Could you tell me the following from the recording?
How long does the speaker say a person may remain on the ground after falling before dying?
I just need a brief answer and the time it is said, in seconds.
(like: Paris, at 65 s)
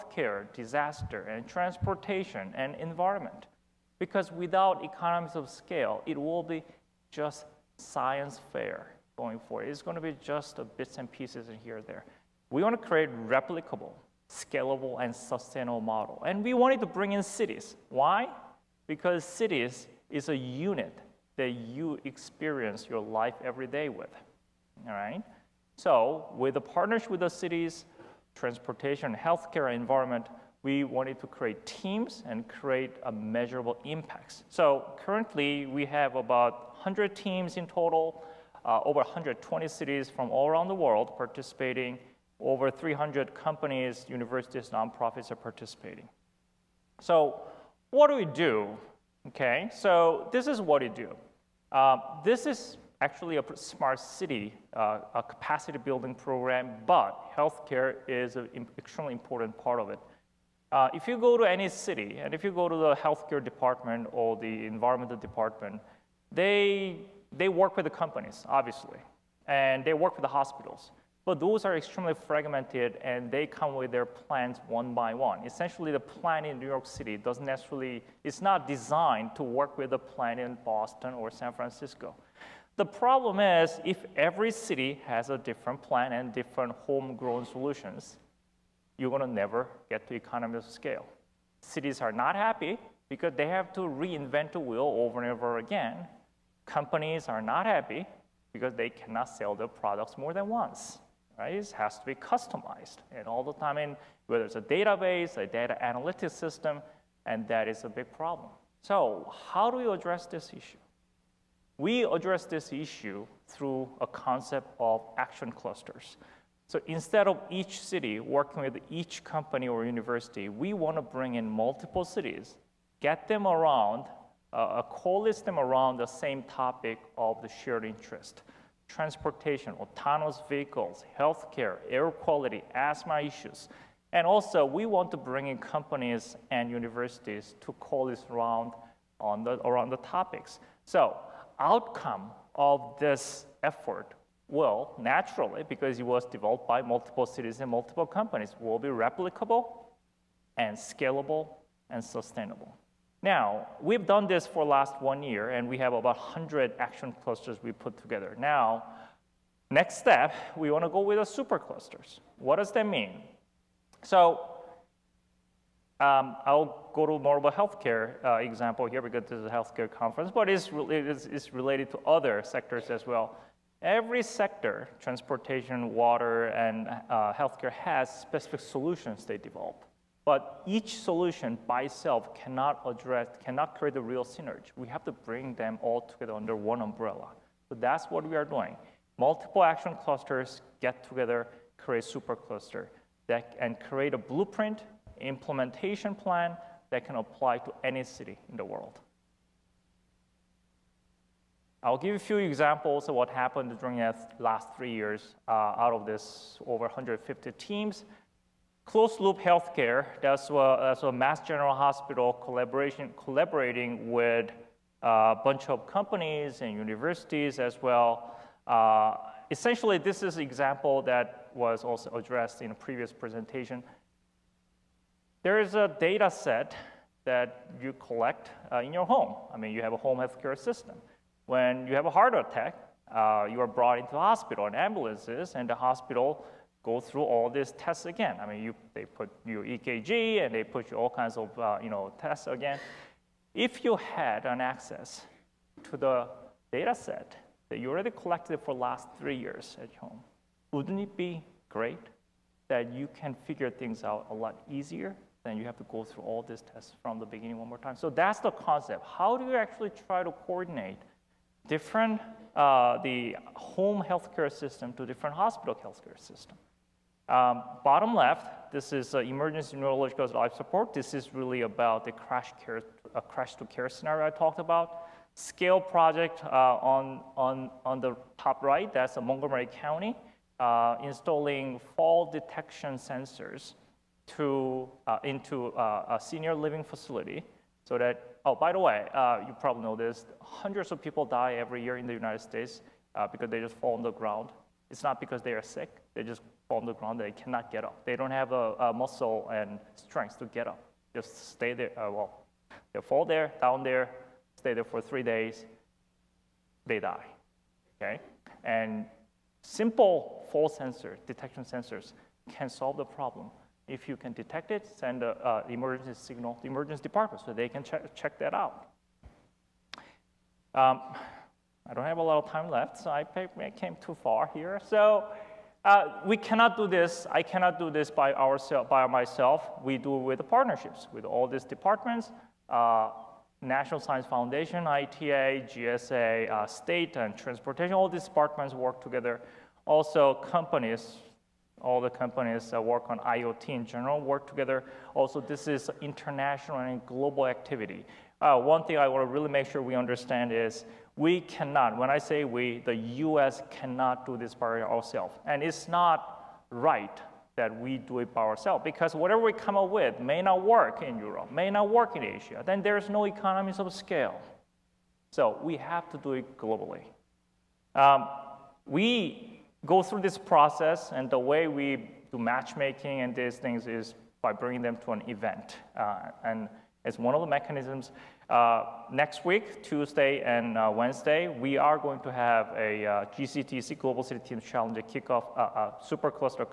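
3 days, at 305 s.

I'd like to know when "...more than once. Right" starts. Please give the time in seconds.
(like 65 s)
100 s.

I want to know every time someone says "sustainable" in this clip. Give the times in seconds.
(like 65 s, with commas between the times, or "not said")
15 s, 152 s.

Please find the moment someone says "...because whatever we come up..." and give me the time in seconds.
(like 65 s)
358 s.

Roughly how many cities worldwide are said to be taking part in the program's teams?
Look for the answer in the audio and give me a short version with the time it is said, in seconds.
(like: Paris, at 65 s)
over 120, at 38 s.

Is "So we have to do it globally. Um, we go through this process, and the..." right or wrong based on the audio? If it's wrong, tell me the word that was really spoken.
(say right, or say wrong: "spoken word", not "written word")
right.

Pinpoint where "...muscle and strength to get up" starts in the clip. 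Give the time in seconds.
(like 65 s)
298 s.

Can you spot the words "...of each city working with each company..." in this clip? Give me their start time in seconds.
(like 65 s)
117 s.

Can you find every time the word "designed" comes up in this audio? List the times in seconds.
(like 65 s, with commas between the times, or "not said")
78 s.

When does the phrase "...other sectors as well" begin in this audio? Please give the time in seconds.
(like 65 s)
172 s.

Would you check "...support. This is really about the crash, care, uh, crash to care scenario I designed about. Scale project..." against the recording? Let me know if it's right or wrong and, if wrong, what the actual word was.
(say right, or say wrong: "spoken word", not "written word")
wrong: "talked", not "designed".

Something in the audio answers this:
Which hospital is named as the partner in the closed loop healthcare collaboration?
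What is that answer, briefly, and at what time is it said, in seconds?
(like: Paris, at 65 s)
Mass General Hospital, at 211 s.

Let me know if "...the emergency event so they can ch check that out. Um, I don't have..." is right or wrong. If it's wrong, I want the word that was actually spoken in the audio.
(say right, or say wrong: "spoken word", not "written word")
wrong: "department", not "event".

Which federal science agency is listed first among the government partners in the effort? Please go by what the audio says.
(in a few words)
National Science Foundation.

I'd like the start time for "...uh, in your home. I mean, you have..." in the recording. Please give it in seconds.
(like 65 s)
228 s.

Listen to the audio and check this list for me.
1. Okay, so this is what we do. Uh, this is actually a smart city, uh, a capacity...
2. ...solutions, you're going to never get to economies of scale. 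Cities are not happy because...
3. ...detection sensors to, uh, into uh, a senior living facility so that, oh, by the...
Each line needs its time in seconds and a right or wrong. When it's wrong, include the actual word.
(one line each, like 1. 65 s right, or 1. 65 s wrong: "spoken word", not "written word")
1. 49 s right
2. 87 s right
3. 282 s right.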